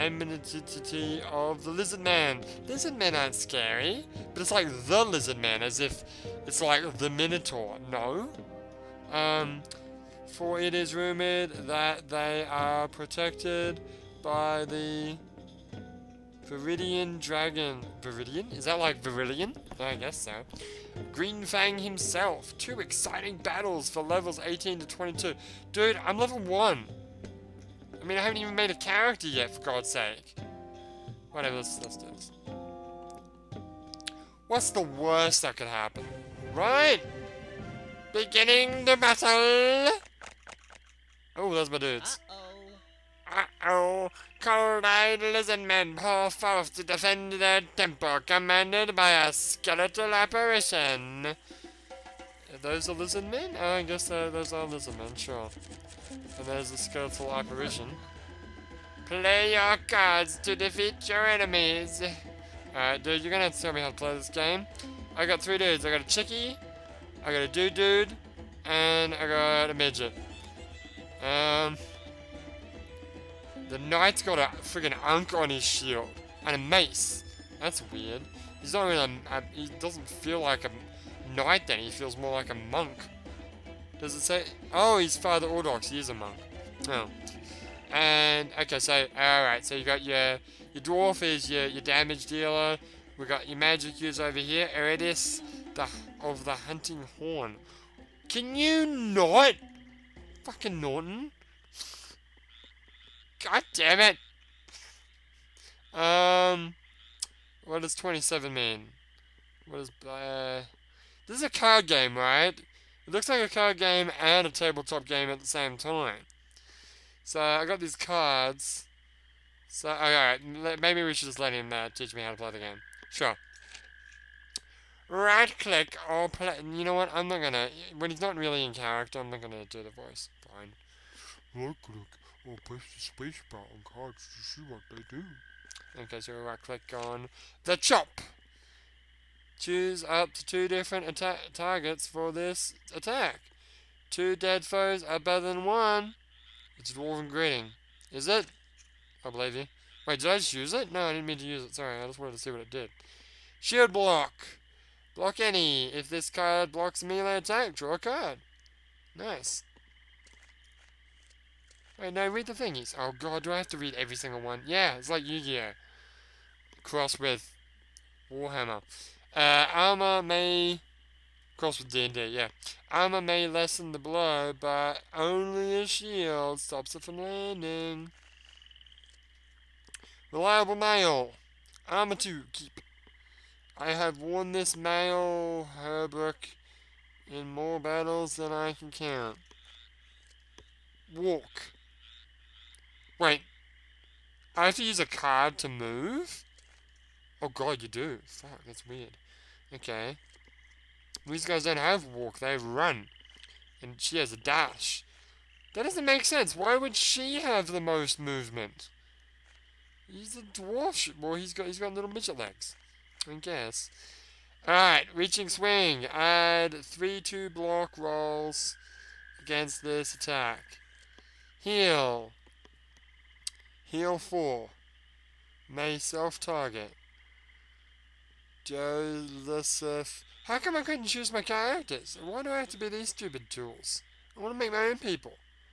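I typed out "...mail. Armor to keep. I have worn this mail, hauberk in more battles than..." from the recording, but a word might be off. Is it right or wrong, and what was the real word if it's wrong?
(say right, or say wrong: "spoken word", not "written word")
right.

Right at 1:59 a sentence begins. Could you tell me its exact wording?
So, oh, alright, maybe we should just let him uh, teach me how to play the game.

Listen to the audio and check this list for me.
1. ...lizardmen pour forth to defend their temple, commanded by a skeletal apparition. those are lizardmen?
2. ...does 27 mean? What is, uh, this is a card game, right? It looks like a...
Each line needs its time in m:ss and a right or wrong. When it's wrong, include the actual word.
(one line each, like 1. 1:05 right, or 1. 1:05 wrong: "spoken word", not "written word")
1. 0:45 right
2. 1:47 right.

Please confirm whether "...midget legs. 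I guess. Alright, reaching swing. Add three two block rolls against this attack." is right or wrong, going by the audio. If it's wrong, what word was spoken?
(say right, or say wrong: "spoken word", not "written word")
right.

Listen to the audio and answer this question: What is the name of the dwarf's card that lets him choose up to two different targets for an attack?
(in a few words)
Dwarven Greeting.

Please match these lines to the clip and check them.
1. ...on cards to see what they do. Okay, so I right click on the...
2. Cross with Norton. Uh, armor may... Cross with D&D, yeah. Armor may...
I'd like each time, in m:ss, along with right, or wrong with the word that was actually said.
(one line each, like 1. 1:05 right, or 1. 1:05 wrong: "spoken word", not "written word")
1. 2:13 right
2. 2:46 wrong: "Warhammer", not "Norton".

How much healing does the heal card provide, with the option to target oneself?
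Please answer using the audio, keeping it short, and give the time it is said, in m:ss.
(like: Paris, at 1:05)
4, at 3:44.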